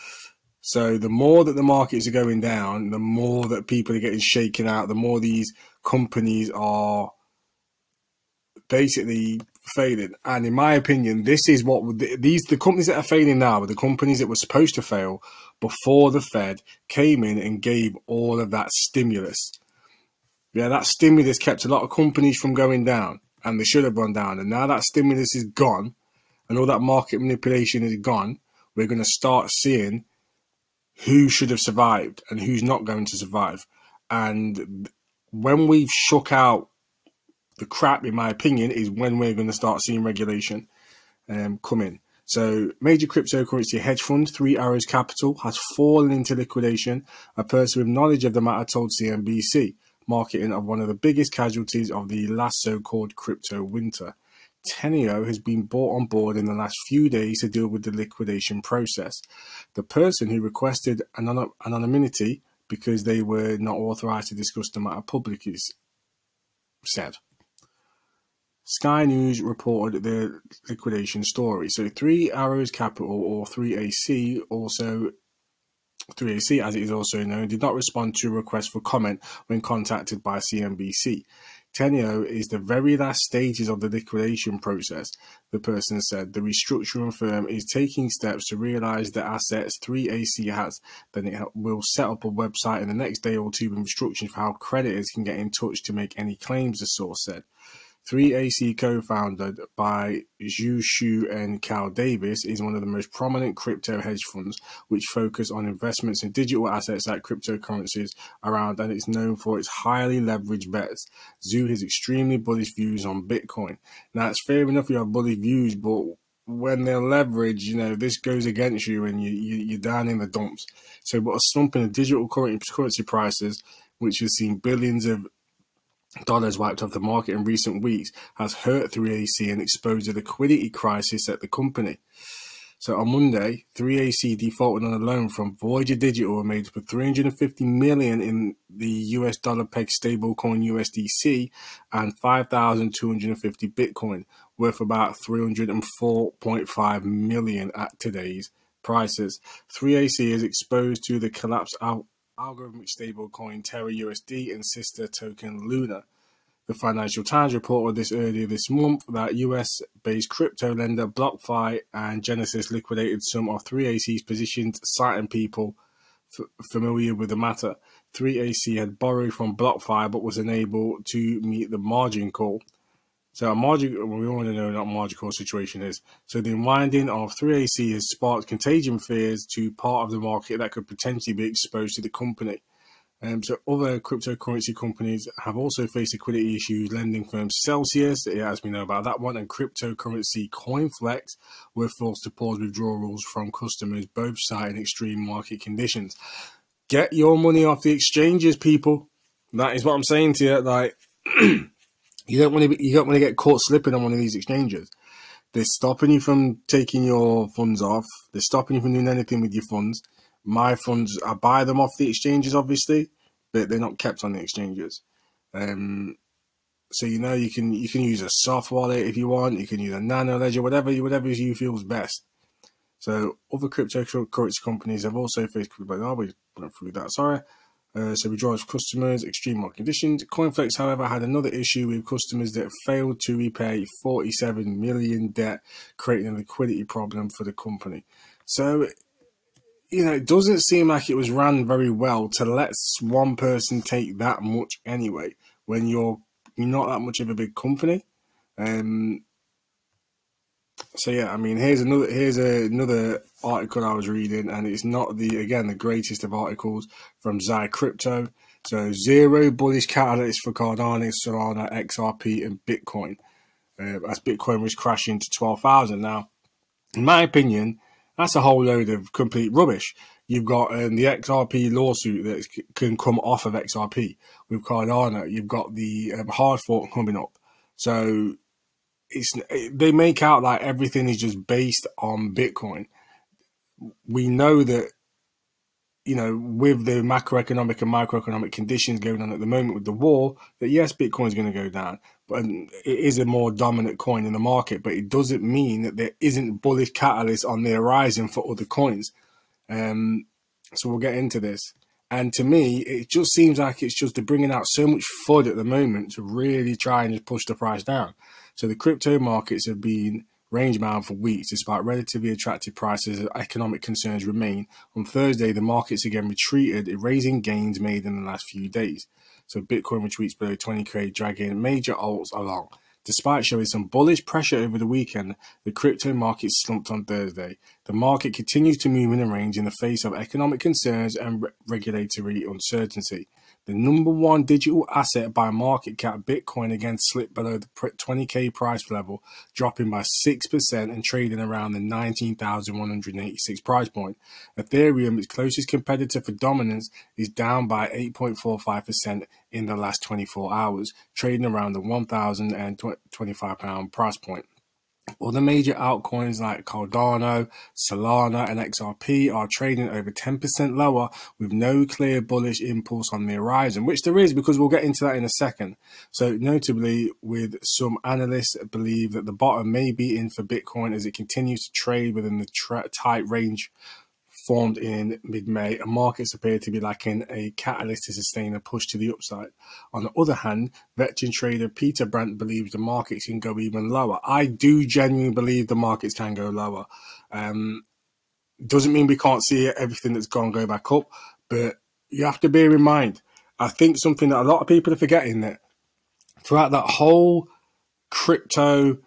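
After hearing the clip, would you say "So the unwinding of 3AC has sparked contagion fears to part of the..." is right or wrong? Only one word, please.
right.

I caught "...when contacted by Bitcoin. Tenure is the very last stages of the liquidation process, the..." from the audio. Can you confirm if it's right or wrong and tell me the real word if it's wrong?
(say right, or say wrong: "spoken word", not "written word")
wrong: "CNBC", not "Bitcoin".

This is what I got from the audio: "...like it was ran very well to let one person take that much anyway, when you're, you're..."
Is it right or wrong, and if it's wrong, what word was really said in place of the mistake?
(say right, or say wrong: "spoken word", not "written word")
right.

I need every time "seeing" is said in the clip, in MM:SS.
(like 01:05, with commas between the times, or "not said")
00:29, 00:39.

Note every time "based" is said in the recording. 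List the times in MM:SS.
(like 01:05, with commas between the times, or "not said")
02:40, 04:41.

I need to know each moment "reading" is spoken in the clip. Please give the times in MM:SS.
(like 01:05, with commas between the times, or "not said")
04:14.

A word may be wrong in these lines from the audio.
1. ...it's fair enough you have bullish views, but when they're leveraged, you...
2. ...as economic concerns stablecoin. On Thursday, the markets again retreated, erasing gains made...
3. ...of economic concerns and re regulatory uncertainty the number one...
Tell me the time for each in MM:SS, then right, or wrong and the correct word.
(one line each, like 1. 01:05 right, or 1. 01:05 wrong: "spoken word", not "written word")
1. 01:54 right
2. 05:13 wrong: "remain", not "stablecoin"
3. 05:30 right.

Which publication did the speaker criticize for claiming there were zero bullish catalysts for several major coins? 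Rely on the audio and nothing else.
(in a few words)
Zy Crypto.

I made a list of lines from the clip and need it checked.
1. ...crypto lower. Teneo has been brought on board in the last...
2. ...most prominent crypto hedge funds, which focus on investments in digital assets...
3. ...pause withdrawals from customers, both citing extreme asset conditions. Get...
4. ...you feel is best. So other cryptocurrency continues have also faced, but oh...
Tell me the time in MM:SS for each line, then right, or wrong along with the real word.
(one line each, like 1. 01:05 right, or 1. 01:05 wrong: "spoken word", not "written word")
1. 00:53 wrong: "winter", not "lower"
2. 01:42 right
3. 03:12 wrong: "market", not "asset"
4. 03:41 wrong: "companies", not "continues".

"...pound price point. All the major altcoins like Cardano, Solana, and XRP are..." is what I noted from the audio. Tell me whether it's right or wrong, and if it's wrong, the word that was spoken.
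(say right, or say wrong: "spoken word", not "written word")
right.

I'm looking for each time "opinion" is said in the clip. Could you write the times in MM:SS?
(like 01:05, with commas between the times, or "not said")
00:10, 00:38, 04:27.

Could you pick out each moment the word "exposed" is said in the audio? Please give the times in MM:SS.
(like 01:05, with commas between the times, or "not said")
02:09, 02:30, 03:01.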